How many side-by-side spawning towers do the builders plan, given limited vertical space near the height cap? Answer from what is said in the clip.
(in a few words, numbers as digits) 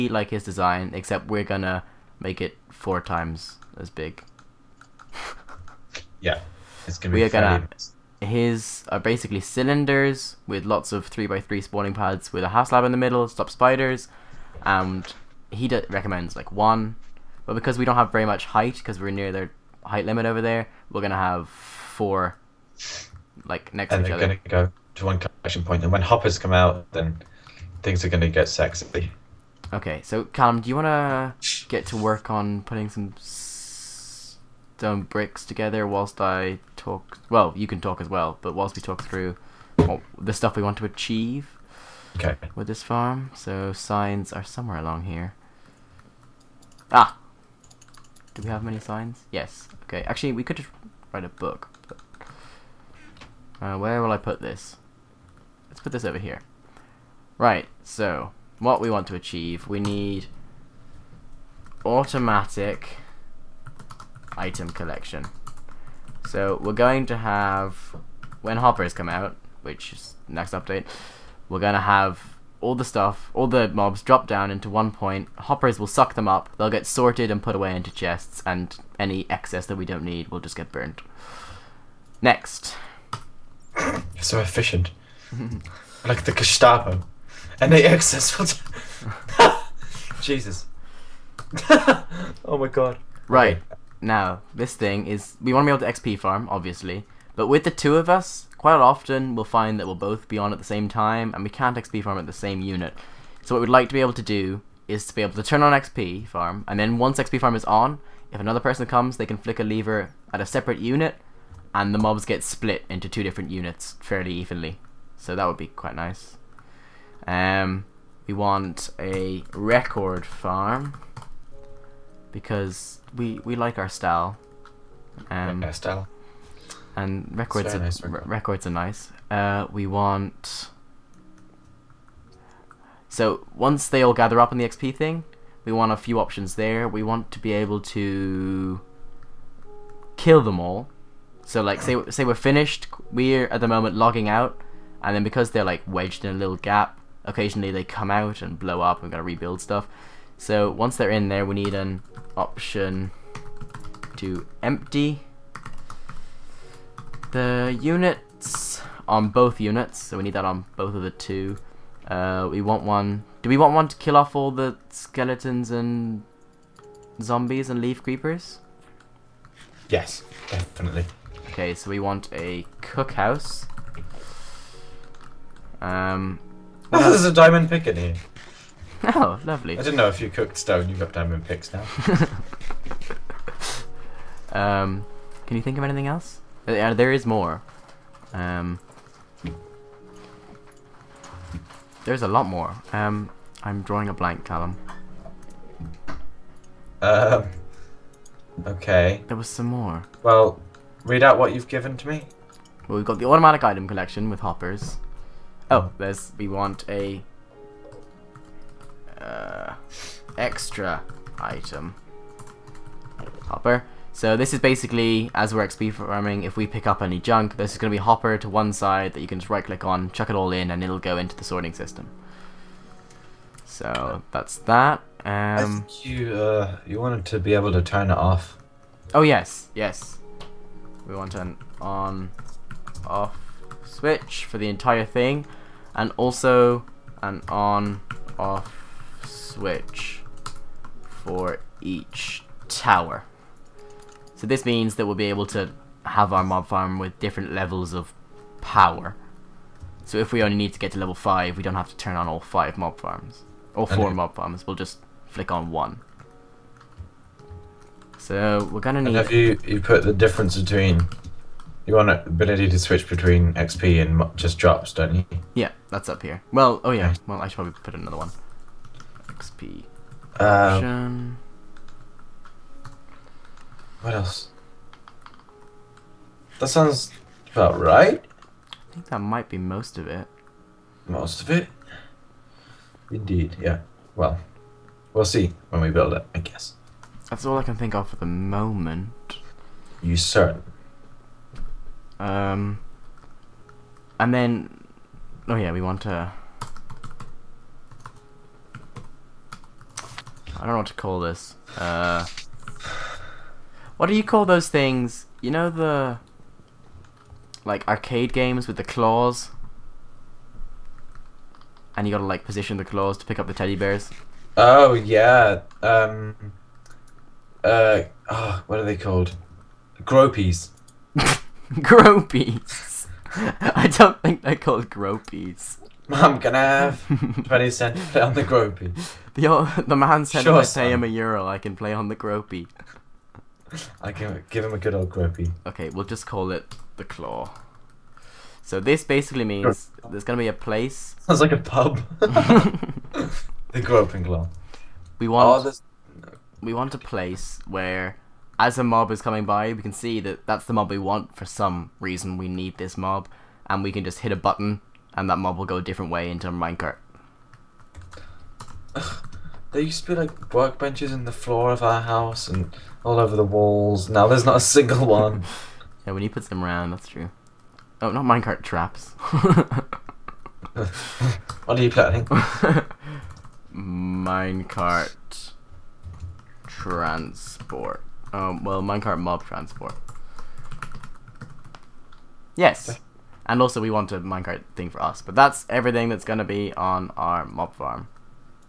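4.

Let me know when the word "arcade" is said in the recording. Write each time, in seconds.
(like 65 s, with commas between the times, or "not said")
307 s.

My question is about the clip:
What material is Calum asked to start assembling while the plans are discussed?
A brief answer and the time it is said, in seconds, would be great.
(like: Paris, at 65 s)
stone bricks, at 33 s.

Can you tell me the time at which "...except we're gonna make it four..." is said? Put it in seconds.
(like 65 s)
0 s.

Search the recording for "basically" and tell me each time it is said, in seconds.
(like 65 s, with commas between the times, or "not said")
9 s, 214 s, 339 s.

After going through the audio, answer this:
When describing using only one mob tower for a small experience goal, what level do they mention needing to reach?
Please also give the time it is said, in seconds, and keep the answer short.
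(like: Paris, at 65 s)
level 5, at 250 s.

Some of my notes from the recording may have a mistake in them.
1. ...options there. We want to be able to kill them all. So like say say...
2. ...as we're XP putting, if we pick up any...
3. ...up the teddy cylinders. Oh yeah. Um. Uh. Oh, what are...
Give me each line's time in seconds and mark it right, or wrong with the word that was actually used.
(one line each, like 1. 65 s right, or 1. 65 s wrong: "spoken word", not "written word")
1. 136 s right
2. 215 s wrong: "farming", not "putting"
3. 313 s wrong: "bears", not "cylinders".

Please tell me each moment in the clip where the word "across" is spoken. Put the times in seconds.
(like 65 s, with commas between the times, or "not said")
not said.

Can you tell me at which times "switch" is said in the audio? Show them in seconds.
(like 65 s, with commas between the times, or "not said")
233 s, 239 s, 262 s.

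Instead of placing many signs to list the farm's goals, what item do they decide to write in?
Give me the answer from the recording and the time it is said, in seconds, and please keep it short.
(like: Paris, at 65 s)
a book, at 51 s.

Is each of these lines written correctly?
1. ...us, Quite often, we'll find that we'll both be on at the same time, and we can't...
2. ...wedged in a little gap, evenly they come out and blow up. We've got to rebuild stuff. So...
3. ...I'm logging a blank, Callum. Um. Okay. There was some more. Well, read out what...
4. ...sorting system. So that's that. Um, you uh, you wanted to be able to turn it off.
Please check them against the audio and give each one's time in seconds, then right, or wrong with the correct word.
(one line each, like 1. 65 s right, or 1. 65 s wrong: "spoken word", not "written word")
1. 98 s right
2. 145 s wrong: "occasionally", not "evenly"
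3. 193 s wrong: "drawing", not "logging"
4. 221 s right.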